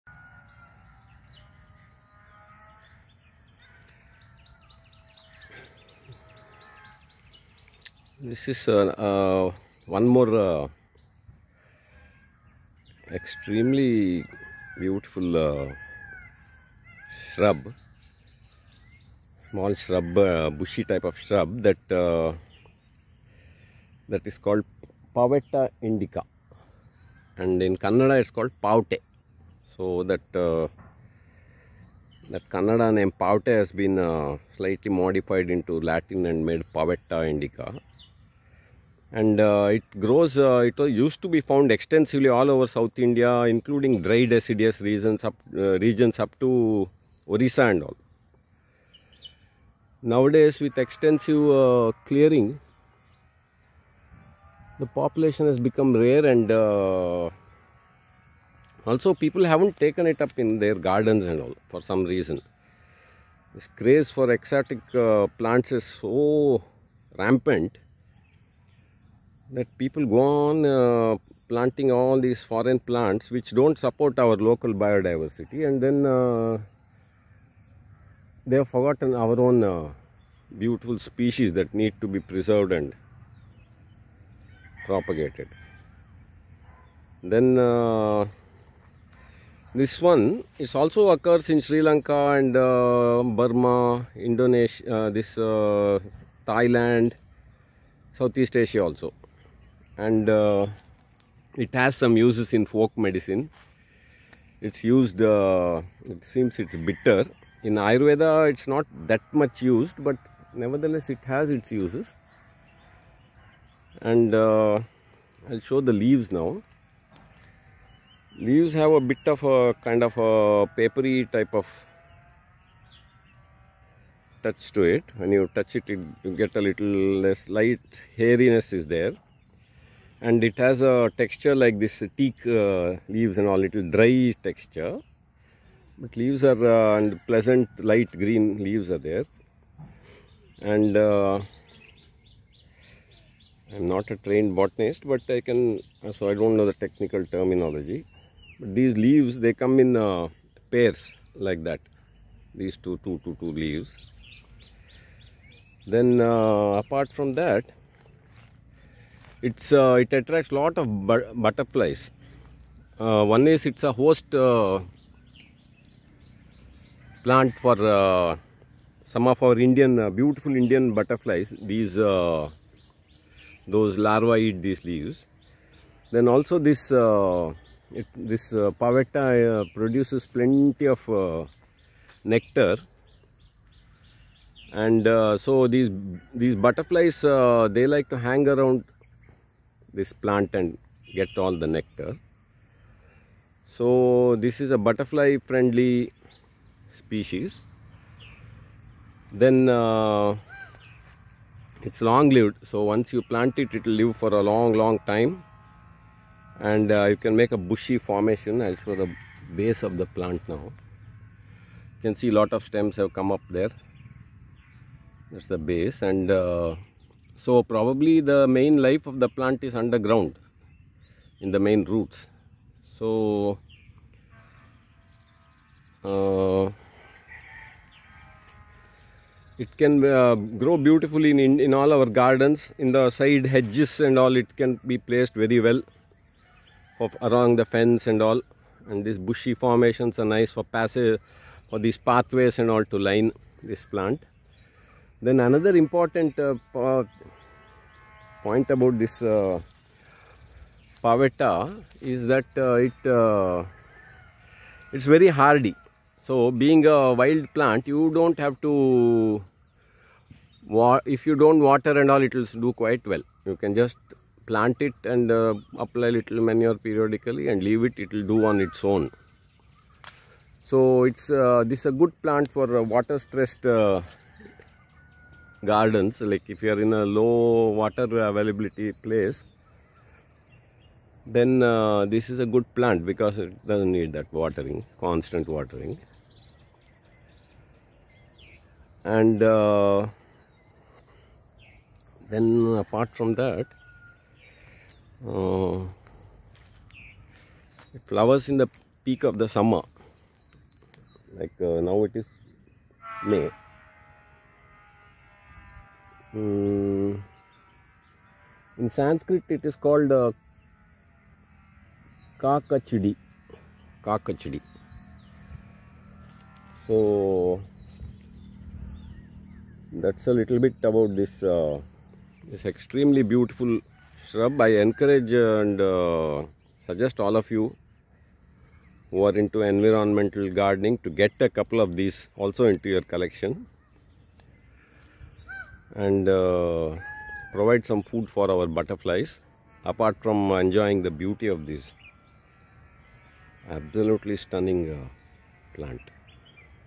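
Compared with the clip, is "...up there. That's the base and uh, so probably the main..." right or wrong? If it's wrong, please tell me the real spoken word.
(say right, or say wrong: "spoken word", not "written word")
right.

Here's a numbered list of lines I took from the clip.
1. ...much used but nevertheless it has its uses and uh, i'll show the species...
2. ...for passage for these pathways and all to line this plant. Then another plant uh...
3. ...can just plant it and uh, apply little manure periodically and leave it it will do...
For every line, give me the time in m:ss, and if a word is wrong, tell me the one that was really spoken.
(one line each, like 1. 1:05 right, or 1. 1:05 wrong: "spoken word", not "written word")
1. 1:49 wrong: "leaves", not "species"
2. 4:00 wrong: "important", not "plant"
3. 4:23 right.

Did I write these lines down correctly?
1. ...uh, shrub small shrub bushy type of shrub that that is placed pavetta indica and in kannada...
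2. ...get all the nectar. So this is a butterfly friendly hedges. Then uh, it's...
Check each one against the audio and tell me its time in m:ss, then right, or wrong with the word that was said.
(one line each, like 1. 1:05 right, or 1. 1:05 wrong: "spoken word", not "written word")
1. 0:15 wrong: "called", not "placed"
2. 3:11 wrong: "species", not "hedges".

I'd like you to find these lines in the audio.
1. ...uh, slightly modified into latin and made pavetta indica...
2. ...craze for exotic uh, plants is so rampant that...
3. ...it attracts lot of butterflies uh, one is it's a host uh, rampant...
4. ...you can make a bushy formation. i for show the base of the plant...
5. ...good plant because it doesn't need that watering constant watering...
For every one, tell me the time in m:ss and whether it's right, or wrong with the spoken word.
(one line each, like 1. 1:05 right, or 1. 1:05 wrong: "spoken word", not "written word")
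1. 0:34 right
2. 1:03 right
3. 2:39 wrong: "plant", not "rampant"
4. 3:27 right
5. 4:42 right.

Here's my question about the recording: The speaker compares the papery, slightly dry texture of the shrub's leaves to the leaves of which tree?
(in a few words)
Teak.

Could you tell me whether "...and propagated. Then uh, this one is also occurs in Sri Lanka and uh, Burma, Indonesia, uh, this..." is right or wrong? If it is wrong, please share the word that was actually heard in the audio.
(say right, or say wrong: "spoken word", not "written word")
right.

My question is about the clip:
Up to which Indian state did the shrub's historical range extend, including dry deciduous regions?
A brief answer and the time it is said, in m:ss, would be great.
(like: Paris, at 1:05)
Orissa, at 0:47.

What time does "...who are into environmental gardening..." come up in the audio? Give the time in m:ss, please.
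5:29.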